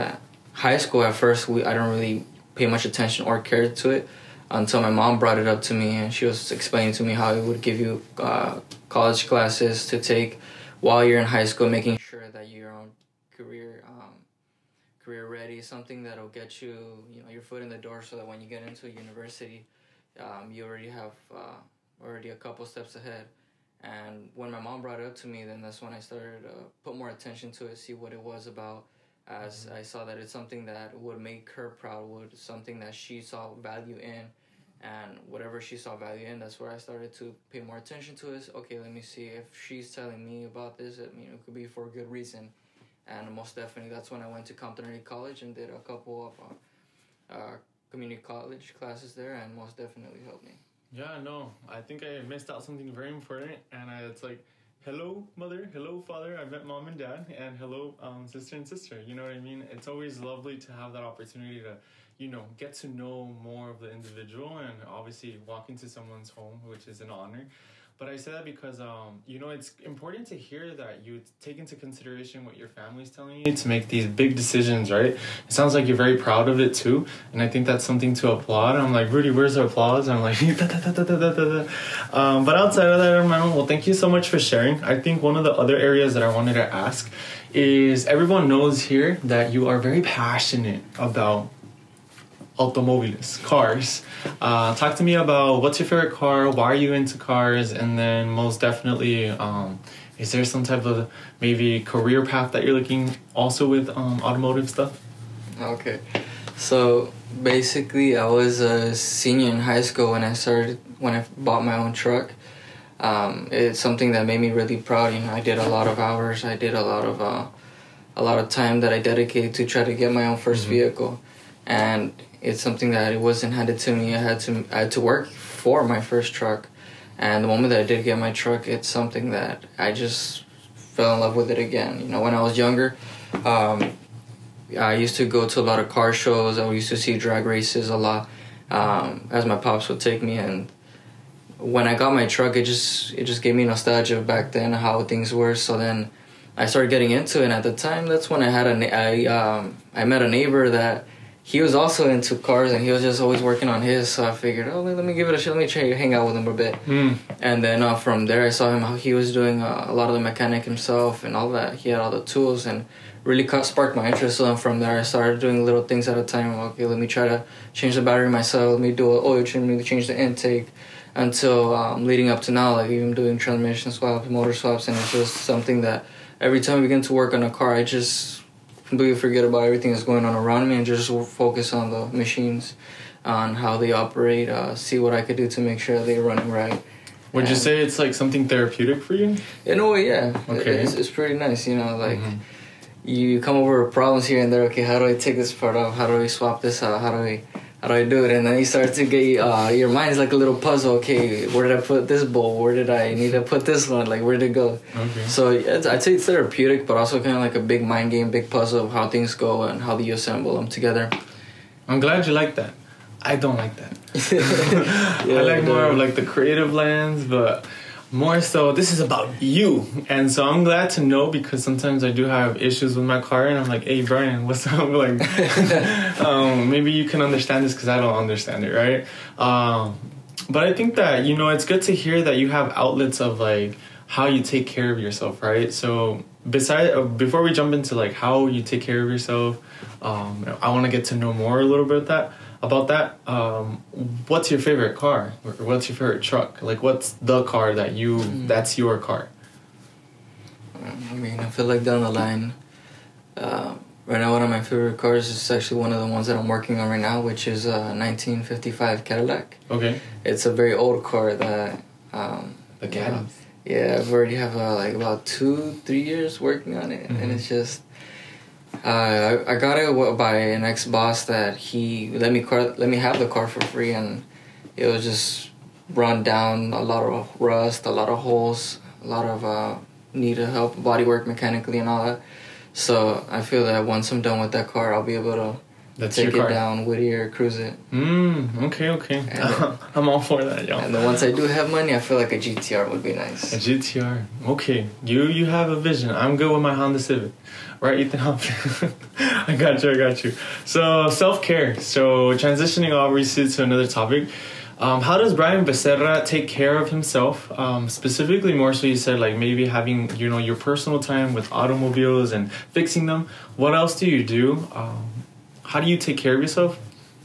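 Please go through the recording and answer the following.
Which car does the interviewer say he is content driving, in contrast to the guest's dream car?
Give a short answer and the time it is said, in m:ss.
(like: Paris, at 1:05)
Honda Civic, at 4:56.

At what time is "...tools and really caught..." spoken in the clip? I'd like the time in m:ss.
2:42.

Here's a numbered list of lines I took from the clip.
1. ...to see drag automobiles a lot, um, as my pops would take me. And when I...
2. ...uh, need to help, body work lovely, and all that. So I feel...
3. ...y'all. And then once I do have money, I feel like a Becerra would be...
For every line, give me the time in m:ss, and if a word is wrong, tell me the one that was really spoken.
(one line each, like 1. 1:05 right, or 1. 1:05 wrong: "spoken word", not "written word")
1. 2:16 wrong: "races", not "automobiles"
2. 4:39 wrong: "mechanically", not "lovely"
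3. 4:50 wrong: "GTR", not "Becerra".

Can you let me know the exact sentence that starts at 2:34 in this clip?
So I figured, oh, let me give it a shot.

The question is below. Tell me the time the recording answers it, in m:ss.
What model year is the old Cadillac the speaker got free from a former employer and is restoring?
4:17.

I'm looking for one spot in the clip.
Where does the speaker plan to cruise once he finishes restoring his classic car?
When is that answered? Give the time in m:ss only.
4:46.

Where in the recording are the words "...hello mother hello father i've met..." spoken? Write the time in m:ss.
0:54.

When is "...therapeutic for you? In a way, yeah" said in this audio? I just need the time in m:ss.
3:08.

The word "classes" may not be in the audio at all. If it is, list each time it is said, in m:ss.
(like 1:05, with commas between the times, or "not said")
0:09, 0:48.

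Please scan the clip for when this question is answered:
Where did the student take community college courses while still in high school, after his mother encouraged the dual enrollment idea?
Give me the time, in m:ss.
0:44.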